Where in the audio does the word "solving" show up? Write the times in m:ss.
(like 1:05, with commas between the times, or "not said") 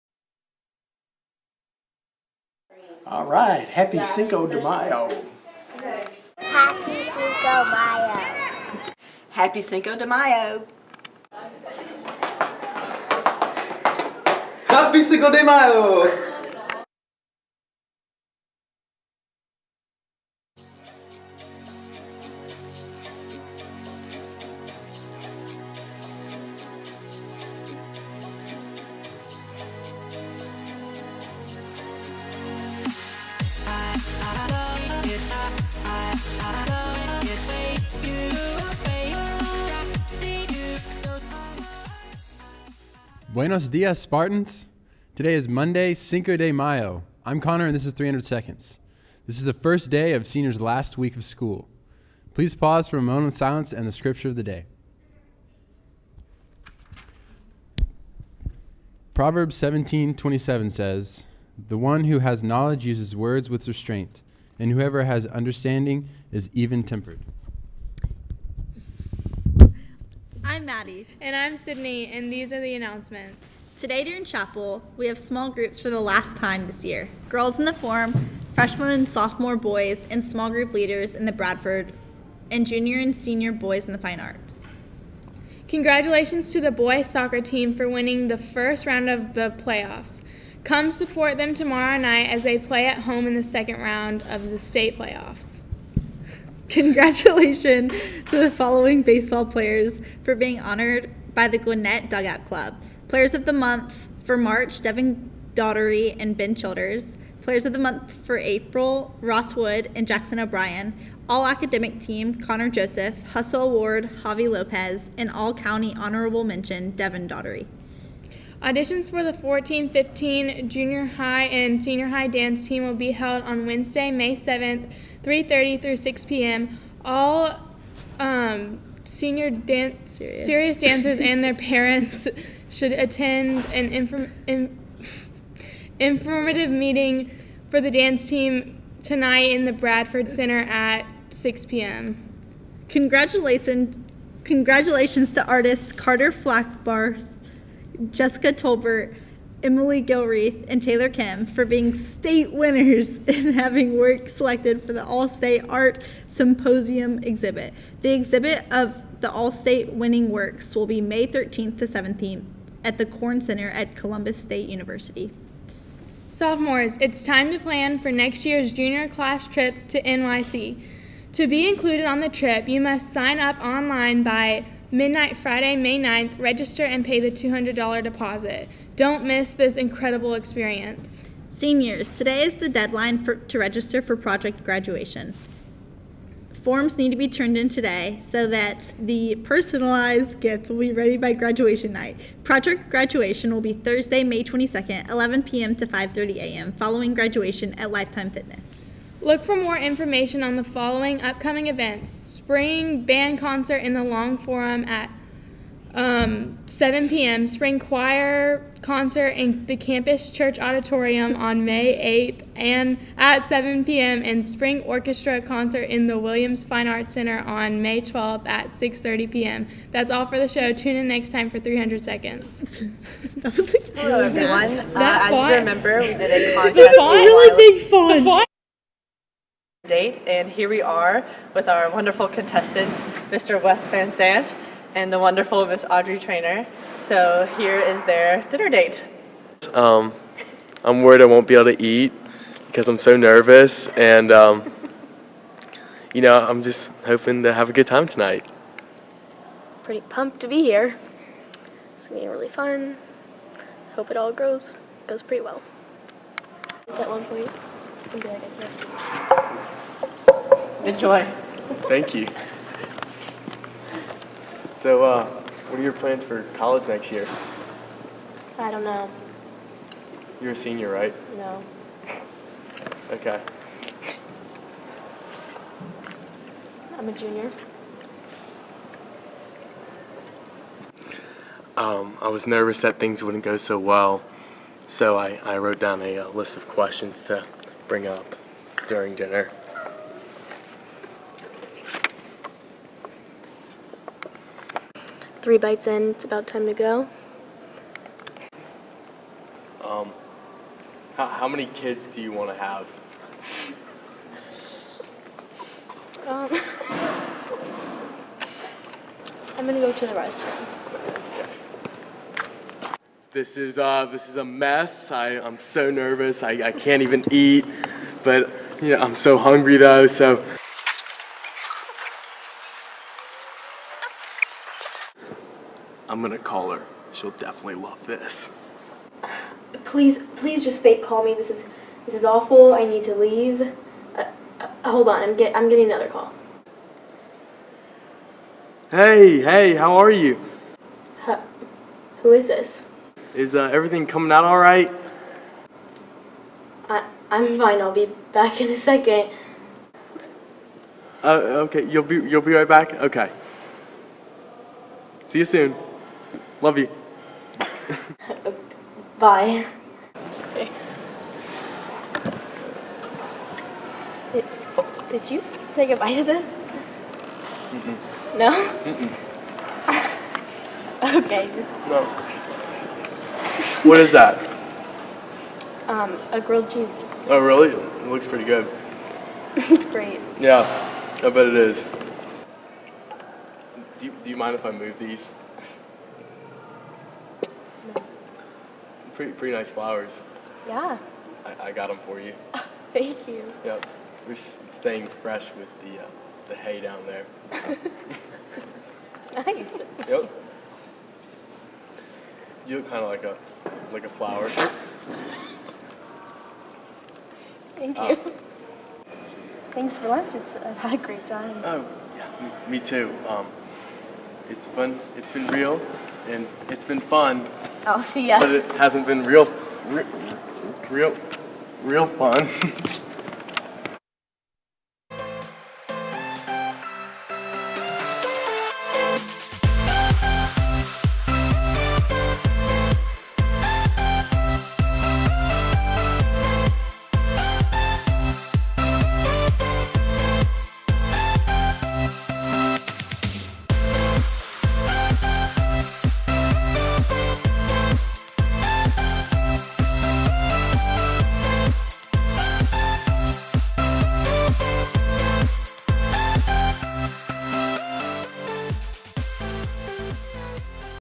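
not said.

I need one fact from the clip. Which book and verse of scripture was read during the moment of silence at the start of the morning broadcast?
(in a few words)
Proverbs 17:27.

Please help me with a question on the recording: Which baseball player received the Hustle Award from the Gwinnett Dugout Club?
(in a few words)
Javi Lopez.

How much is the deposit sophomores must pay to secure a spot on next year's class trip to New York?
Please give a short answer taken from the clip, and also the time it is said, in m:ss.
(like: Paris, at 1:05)
$200, at 2:57.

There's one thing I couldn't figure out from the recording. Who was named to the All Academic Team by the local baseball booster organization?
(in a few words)
Connor Joseph.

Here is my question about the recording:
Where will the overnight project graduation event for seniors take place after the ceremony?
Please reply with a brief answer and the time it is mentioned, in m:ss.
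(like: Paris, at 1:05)
Lifetime Fitness, at 3:17.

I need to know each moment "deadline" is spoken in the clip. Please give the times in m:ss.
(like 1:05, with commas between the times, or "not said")
3:02.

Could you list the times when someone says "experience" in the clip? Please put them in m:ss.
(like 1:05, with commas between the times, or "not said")
3:00.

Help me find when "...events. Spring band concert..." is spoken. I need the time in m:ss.
3:21.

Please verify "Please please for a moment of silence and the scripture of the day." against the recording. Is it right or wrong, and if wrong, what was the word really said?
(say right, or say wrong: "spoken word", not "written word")
wrong: "pause", not "please".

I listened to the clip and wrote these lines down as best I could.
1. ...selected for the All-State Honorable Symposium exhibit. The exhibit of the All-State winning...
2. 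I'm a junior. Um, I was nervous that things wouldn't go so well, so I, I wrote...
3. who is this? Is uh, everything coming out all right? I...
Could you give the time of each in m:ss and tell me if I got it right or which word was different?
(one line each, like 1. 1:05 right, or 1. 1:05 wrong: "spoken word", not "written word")
1. 2:34 wrong: "Art", not "Honorable"
2. 4:36 right
3. 5:42 right.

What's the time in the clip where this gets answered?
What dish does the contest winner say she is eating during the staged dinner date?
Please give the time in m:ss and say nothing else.
6:16.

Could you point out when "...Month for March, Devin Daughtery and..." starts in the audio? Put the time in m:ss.
1:43.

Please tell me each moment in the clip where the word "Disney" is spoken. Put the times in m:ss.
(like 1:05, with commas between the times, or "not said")
not said.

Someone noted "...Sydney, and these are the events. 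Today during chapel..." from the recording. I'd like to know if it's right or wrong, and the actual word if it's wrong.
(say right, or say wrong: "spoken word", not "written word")
wrong: "announcements", not "events".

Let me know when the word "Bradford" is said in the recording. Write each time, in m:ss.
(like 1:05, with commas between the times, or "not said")
1:21, 2:19.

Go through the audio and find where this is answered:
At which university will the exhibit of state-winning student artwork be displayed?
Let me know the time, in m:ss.
2:43.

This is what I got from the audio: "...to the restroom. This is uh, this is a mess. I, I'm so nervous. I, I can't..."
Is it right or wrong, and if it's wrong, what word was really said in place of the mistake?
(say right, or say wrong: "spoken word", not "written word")
right.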